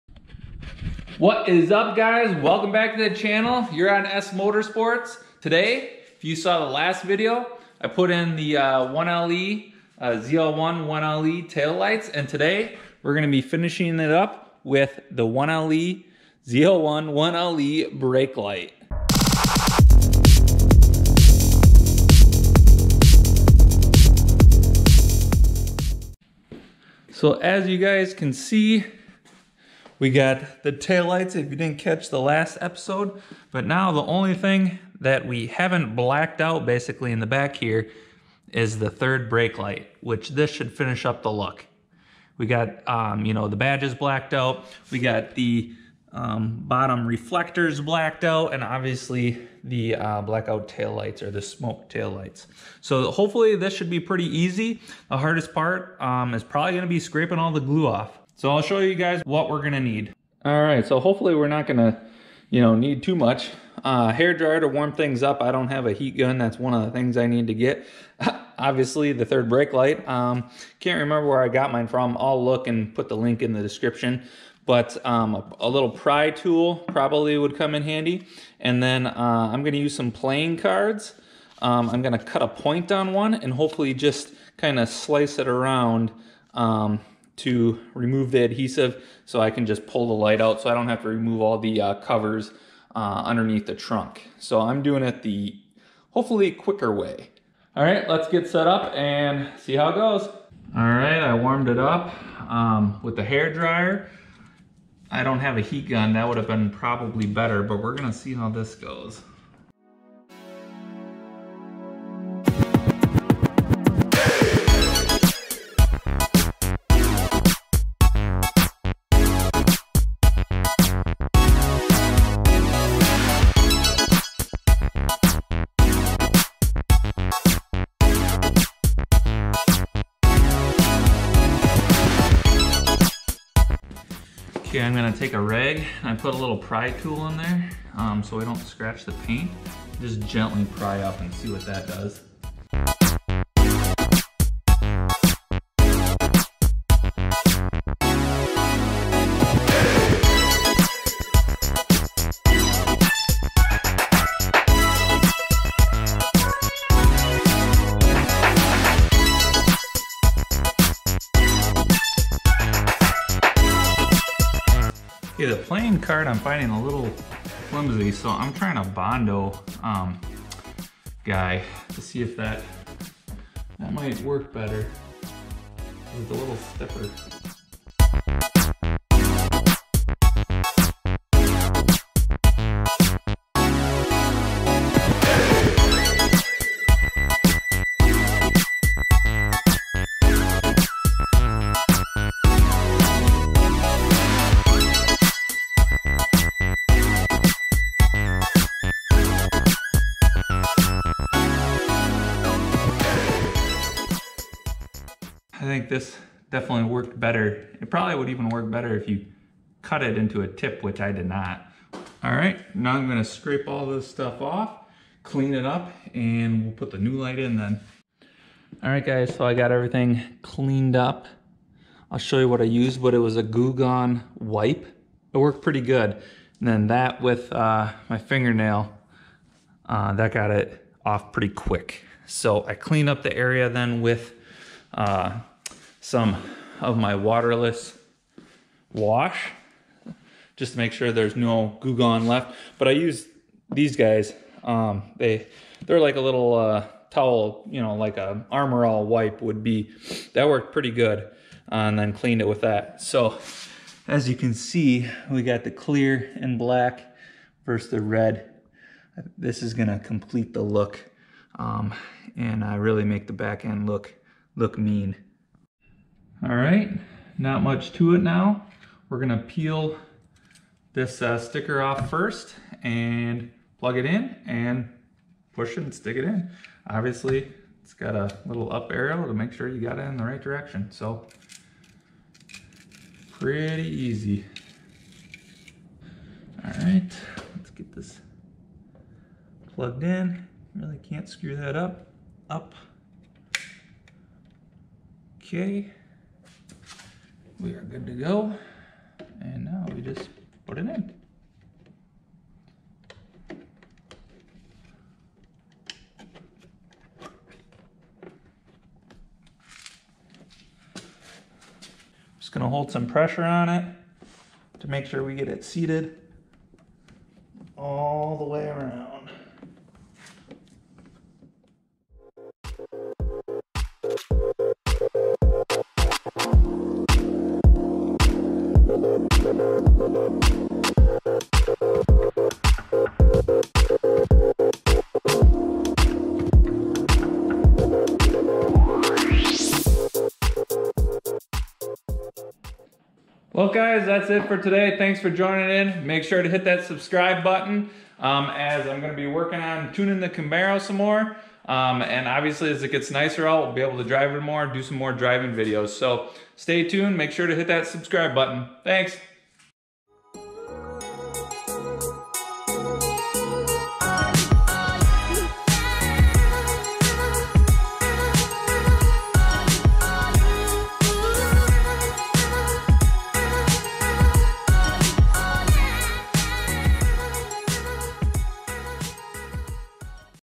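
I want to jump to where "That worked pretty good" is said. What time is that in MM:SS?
04:10.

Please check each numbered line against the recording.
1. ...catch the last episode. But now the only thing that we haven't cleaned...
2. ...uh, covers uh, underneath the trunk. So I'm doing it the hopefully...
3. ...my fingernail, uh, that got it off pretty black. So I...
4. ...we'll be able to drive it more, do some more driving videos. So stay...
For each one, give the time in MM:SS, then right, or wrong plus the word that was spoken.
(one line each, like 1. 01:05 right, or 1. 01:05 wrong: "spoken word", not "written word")
1. 00:31 wrong: "blacked", not "cleaned"
2. 01:31 right
3. 03:48 wrong: "quick", not "black"
4. 05:53 right.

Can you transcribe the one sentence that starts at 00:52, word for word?
So hopefully this should be pretty easy.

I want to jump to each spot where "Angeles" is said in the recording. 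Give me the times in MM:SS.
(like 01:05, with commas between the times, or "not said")
not said.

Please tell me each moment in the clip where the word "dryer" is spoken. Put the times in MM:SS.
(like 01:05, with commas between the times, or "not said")
01:04, 01:43.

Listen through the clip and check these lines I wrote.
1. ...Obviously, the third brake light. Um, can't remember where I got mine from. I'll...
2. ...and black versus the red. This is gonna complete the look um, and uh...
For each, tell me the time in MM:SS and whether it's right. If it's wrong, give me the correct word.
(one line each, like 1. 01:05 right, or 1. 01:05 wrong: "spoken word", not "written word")
1. 01:08 right
2. 04:16 right.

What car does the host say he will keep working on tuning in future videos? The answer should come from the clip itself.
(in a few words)
Camaro.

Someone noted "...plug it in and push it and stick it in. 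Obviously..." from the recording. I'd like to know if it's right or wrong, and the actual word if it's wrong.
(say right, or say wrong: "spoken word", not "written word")
right.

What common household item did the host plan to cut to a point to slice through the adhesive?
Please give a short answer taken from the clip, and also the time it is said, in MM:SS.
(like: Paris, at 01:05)
Playing cards, at 01:20.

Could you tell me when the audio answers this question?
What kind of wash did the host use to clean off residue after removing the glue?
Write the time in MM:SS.
03:57.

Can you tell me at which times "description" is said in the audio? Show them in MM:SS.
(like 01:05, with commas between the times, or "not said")
01:13.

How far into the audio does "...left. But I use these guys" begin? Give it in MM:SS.
04:02.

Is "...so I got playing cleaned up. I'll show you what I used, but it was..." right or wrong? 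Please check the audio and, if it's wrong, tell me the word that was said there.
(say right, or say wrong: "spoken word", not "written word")
wrong: "everything", not "playing".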